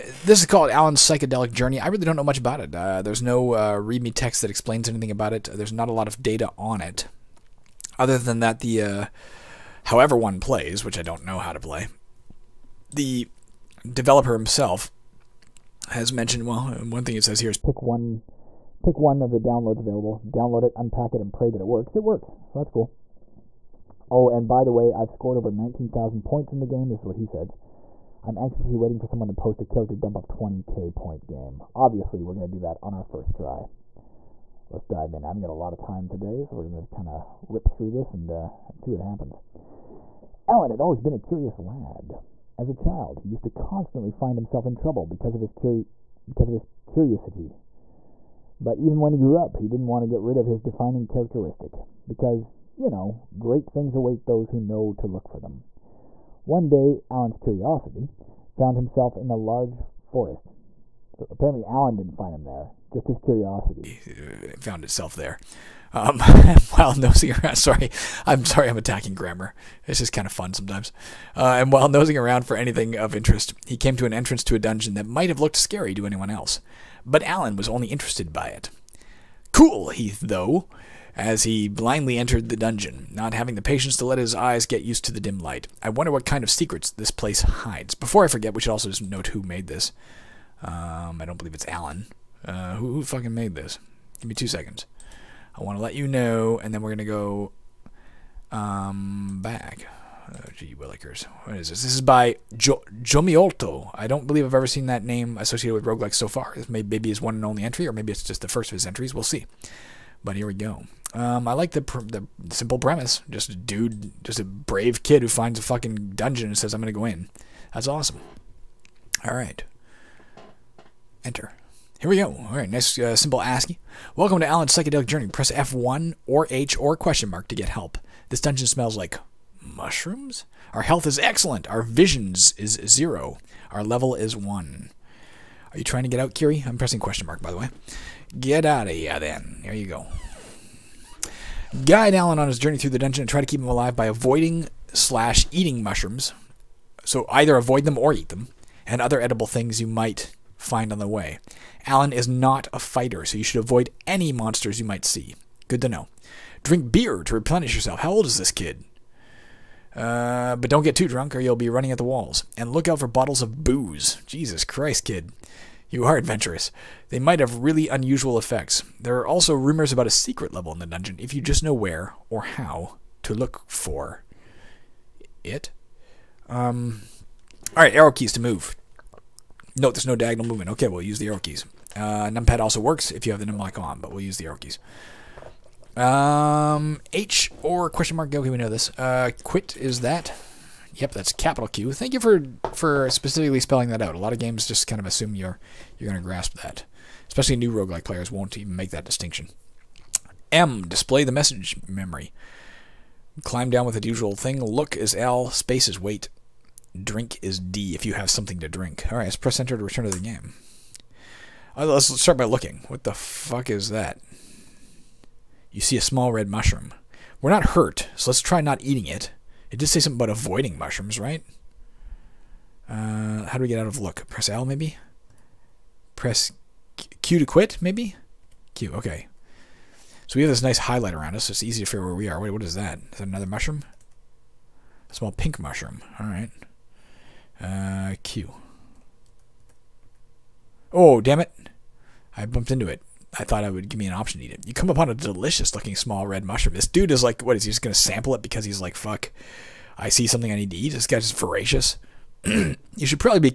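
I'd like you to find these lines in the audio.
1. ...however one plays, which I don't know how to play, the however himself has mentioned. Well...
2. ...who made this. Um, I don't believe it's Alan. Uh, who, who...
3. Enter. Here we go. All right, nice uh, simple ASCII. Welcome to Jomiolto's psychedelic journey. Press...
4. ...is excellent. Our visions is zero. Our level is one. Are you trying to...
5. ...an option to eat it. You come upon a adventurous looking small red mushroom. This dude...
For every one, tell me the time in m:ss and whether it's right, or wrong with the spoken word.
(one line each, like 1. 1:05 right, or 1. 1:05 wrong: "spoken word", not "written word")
1. 0:09 wrong: "developer", not "however"
2. 1:29 right
3. 2:01 wrong: "Alan", not "Jomiolto"
4. 2:11 right
5. 4:04 wrong: "delicious", not "adventurous".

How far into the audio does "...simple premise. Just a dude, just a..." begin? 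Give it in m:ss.
1:52.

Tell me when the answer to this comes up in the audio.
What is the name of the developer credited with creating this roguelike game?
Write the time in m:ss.
1:43.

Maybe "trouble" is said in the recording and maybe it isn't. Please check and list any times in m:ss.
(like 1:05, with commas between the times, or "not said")
0:44.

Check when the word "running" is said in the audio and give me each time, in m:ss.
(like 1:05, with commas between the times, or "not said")
2:41.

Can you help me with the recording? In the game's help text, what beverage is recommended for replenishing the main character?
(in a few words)
Beer.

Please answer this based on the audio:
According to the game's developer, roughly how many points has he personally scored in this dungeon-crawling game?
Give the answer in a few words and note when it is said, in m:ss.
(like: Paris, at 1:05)
19,000, at 0:25.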